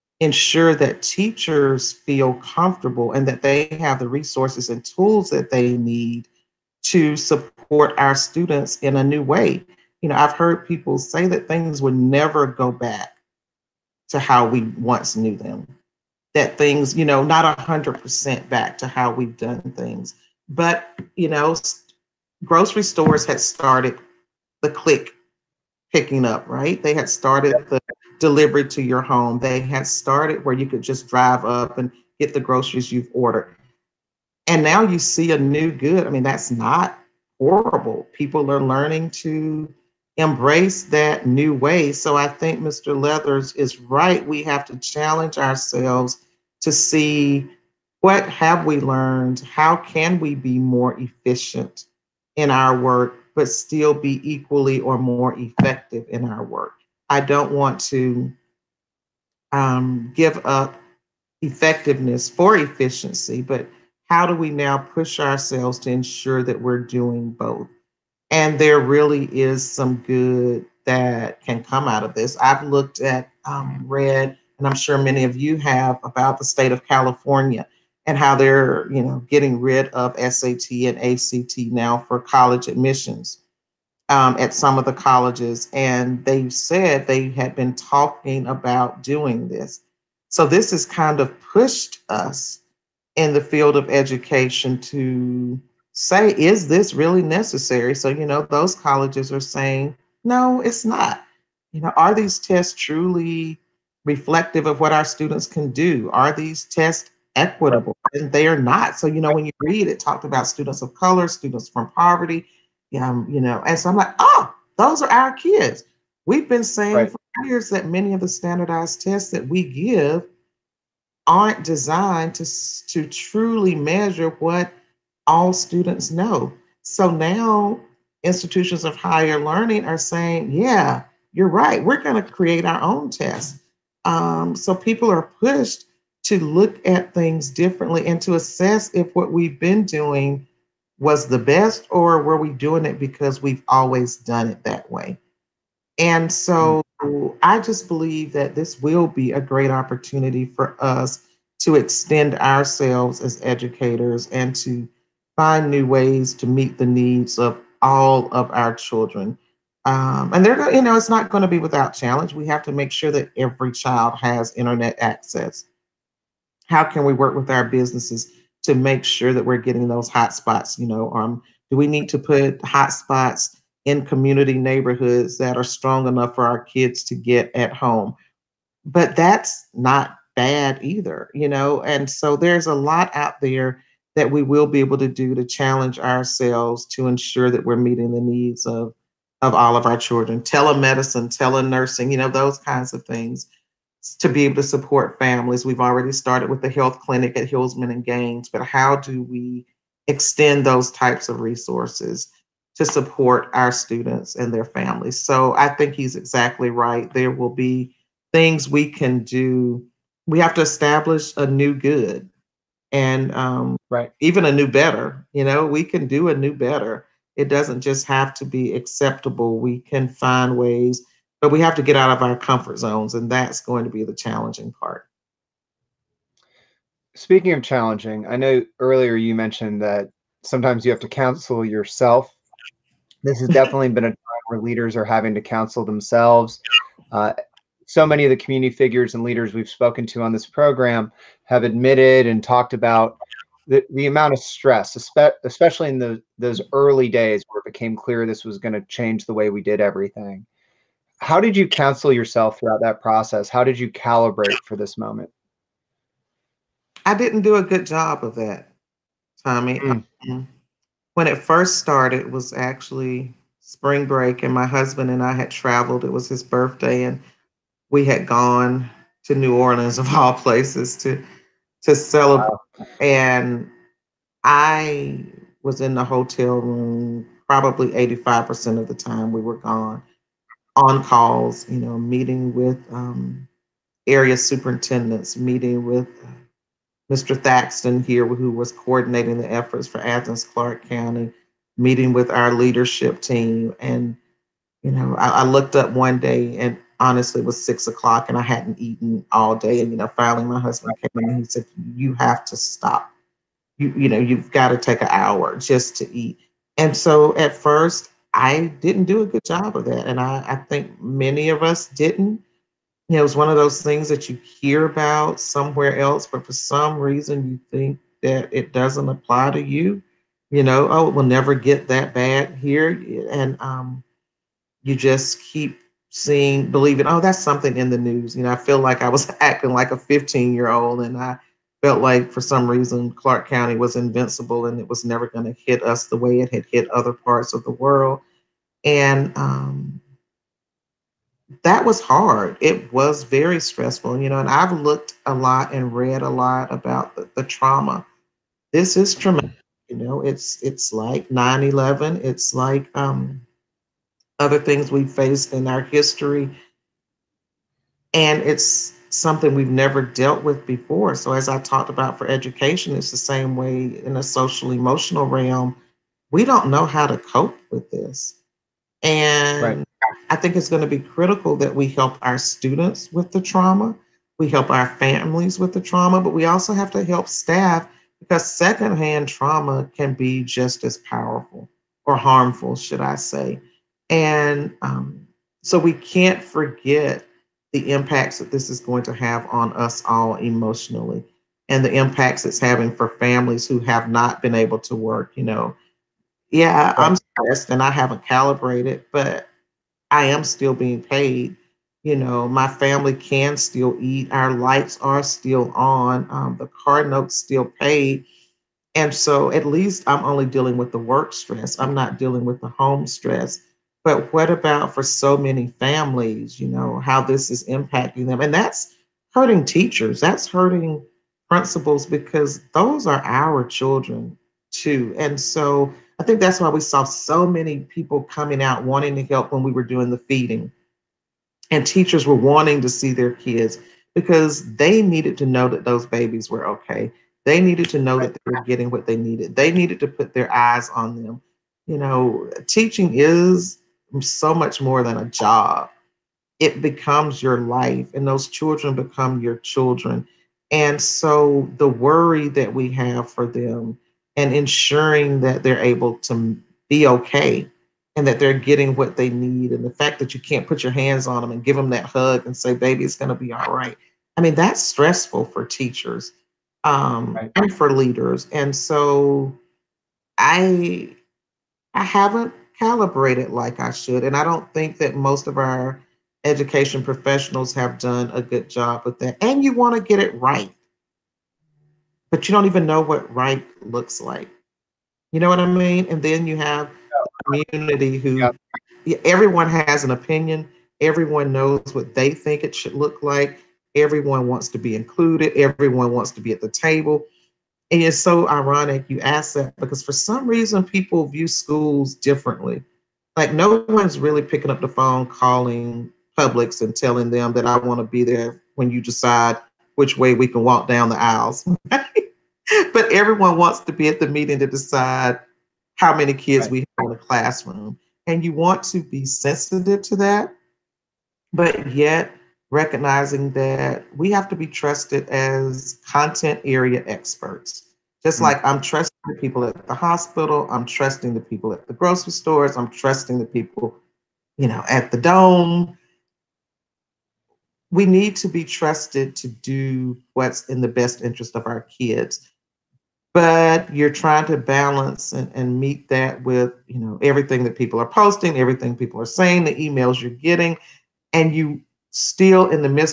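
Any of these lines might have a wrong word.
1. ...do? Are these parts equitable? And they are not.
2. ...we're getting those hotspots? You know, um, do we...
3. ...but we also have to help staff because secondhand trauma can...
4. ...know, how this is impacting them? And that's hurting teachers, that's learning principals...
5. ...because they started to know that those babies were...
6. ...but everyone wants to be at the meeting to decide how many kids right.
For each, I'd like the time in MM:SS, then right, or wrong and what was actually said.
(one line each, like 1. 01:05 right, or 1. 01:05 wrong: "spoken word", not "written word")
1. 01:45 wrong: "tests", not "parts"
2. 02:49 right
3. 06:16 right
4. 06:56 wrong: "hurting", not "learning"
5. 07:14 wrong: "needed", not "started"
6. 08:31 right.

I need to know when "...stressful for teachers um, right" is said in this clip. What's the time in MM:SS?
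07:44.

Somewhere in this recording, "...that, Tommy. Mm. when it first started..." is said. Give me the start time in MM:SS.
04:18.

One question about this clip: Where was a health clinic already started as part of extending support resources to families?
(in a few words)
Hilsman and Gaines.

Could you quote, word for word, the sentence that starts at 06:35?
You know, yeah, I'm stressed and I haven't calibrated, but I am still being paid.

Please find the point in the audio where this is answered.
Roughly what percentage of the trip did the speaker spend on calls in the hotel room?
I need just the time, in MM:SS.
04:37.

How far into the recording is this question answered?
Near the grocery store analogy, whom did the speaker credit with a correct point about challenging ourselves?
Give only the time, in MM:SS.
00:42.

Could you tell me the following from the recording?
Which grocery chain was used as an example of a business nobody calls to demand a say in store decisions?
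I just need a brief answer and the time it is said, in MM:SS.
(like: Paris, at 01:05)
Publix, at 08:26.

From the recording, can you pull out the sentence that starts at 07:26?
It becomes your life, and those children become your children.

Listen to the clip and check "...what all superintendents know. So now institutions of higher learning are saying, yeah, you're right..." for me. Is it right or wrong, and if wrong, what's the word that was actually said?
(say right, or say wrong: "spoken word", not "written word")
wrong: "students", not "superintendents".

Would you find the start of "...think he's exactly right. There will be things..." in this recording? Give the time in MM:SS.
03:25.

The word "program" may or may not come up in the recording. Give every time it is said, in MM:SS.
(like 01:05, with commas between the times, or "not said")
04:00.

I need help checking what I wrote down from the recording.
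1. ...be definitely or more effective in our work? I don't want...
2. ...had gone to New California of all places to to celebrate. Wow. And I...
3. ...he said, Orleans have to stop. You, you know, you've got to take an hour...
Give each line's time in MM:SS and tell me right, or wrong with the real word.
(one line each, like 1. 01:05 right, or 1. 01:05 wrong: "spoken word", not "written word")
1. 00:53 wrong: "equally", not "definitely"
2. 04:28 wrong: "Orleans", not "California"
3. 05:01 wrong: "You", not "Orleans".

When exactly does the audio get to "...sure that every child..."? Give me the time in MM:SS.
02:42.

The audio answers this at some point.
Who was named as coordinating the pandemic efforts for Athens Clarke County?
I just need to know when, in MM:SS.
04:47.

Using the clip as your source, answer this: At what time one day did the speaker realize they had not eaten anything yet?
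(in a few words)
6:00.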